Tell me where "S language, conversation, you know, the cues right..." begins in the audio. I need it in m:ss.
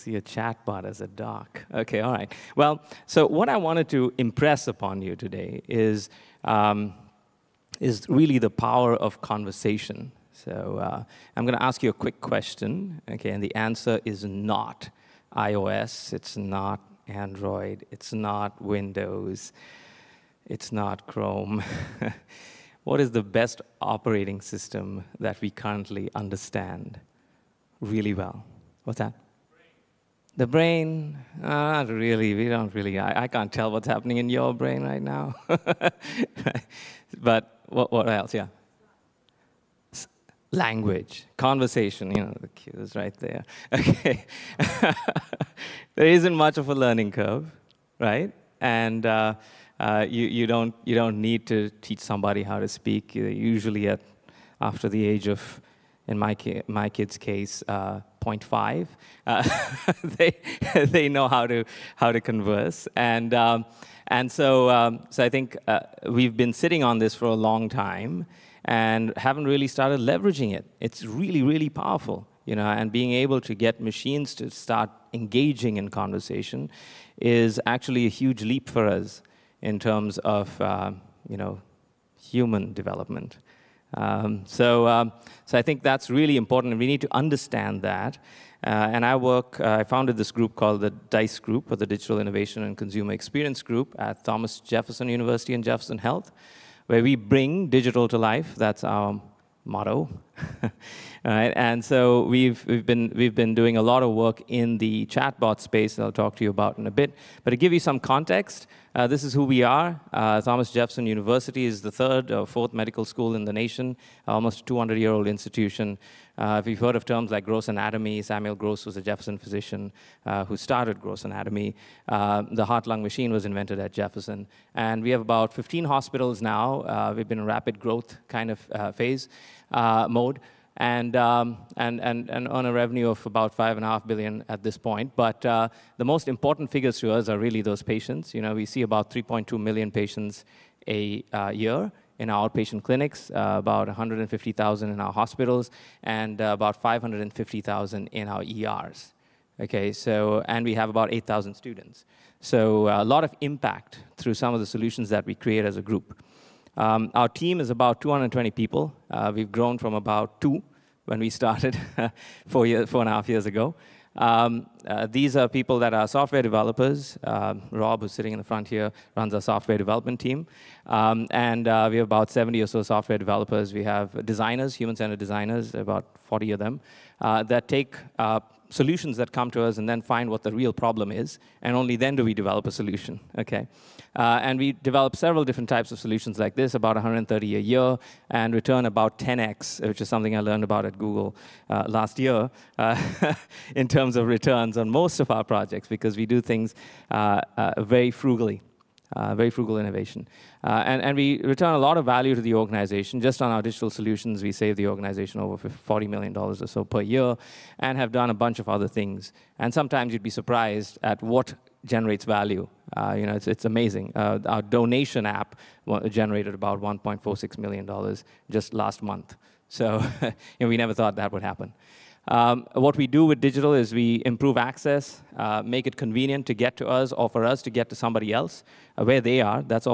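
0:39.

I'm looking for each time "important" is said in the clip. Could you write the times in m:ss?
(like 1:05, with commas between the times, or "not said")
1:26, 2:16.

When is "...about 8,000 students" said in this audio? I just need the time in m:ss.
2:30.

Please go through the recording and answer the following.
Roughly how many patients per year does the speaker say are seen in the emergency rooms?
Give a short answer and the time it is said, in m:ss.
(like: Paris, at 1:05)
550,000, at 2:26.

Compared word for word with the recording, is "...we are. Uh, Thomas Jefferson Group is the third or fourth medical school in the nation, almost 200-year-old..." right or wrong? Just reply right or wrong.
wrong.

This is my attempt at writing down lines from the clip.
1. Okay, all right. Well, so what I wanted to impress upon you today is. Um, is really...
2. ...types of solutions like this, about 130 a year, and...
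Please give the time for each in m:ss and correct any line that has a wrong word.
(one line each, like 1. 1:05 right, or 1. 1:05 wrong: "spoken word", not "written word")
1. 0:01 right
2. 3:05 right.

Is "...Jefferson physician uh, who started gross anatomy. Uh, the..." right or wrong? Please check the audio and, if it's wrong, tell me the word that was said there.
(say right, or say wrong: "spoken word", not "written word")
right.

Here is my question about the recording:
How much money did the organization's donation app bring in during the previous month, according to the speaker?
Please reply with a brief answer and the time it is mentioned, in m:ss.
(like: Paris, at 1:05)
$1.46 million, at 3:36.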